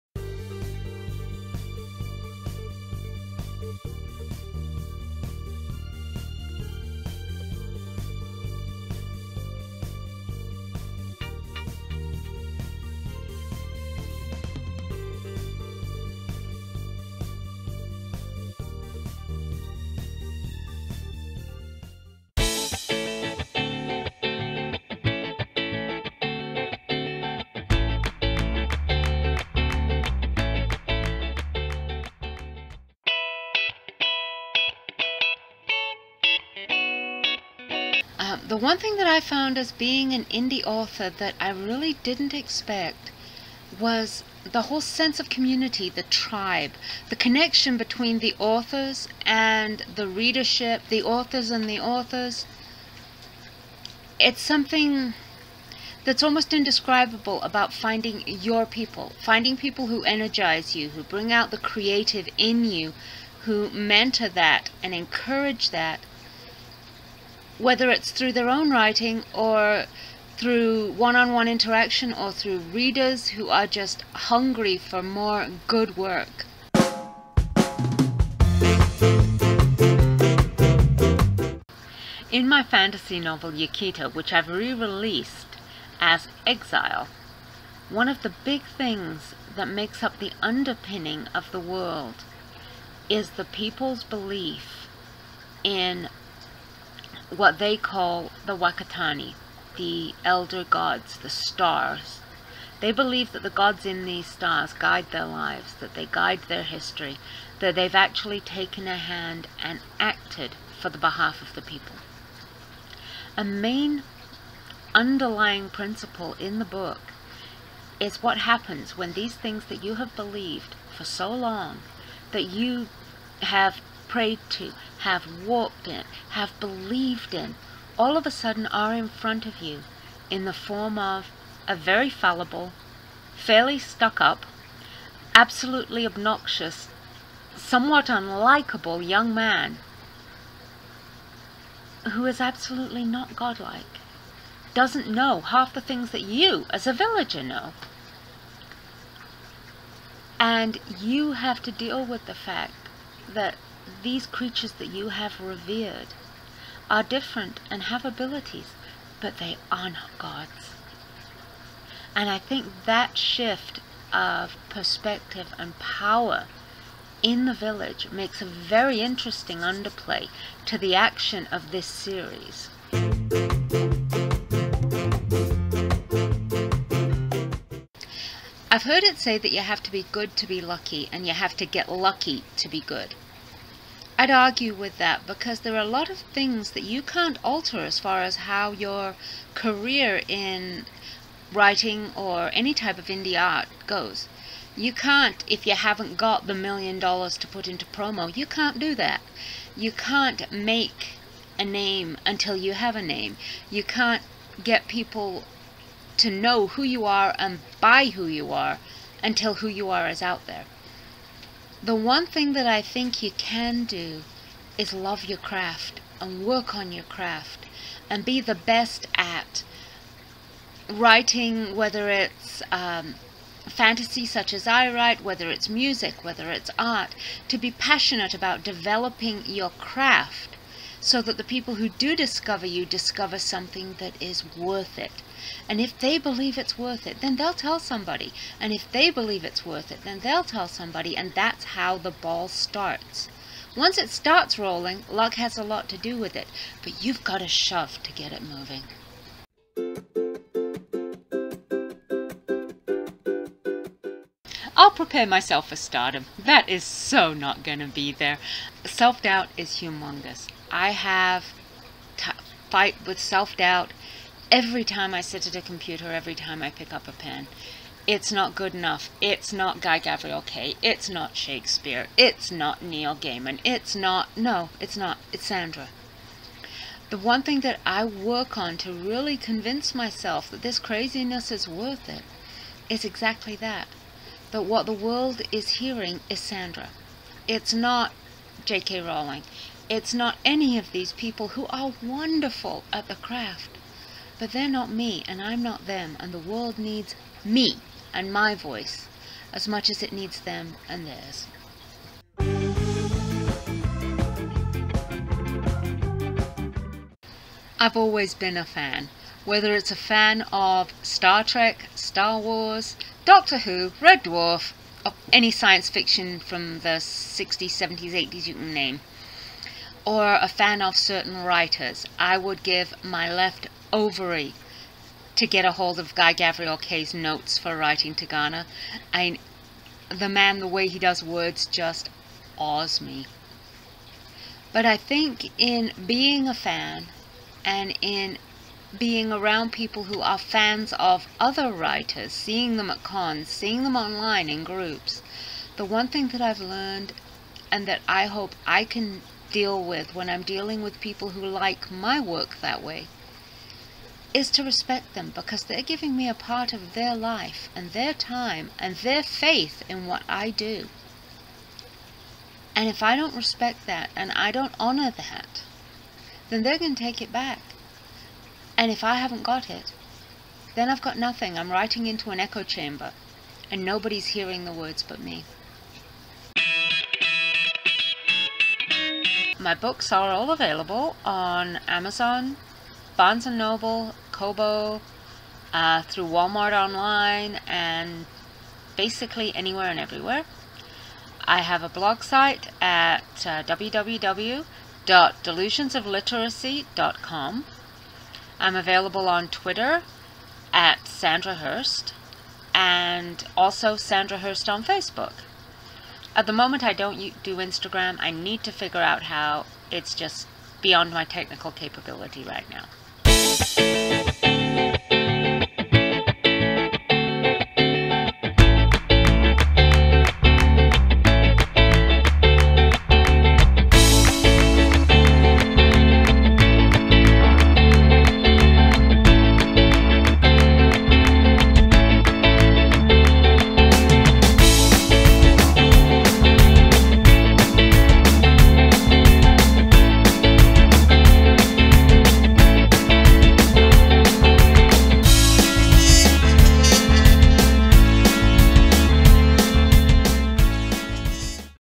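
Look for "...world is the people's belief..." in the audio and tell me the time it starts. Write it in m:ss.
1:31.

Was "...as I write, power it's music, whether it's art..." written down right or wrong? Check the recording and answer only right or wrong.
wrong.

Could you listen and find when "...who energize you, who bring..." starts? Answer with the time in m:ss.
0:59.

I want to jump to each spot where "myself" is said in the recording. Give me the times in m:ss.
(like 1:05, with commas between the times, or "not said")
4:15, 4:39.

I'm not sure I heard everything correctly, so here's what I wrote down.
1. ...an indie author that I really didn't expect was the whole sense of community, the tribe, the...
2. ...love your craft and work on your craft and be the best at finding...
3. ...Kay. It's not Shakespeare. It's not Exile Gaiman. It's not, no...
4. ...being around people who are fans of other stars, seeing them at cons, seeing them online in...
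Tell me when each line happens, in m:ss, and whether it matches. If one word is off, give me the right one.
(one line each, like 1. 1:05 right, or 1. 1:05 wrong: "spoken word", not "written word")
1. 0:40 right
2. 3:34 wrong: "writing", not "finding"
3. 4:30 wrong: "Neil", not "Exile"
4. 5:38 wrong: "writers", not "stars".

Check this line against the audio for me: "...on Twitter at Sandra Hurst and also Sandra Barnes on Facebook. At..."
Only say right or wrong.
wrong.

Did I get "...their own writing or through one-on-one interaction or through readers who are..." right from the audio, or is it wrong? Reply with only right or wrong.
right.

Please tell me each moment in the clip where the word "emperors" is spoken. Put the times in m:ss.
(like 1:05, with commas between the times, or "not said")
not said.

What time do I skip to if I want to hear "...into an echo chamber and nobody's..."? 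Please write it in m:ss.
6:12.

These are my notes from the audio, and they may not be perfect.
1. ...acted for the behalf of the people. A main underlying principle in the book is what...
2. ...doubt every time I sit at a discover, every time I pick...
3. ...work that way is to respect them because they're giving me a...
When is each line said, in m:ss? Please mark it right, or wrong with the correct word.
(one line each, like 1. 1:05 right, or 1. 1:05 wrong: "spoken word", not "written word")
1. 1:49 right
2. 4:23 wrong: "computer", not "discover"
3. 5:52 right.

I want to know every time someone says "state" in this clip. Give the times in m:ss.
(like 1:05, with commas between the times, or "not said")
not said.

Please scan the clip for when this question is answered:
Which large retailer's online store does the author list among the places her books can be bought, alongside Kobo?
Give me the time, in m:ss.
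6:26.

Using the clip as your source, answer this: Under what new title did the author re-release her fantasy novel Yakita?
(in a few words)
Exile.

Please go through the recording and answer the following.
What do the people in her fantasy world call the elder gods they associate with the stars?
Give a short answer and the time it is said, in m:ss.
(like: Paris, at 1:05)
Wakatani, at 1:38.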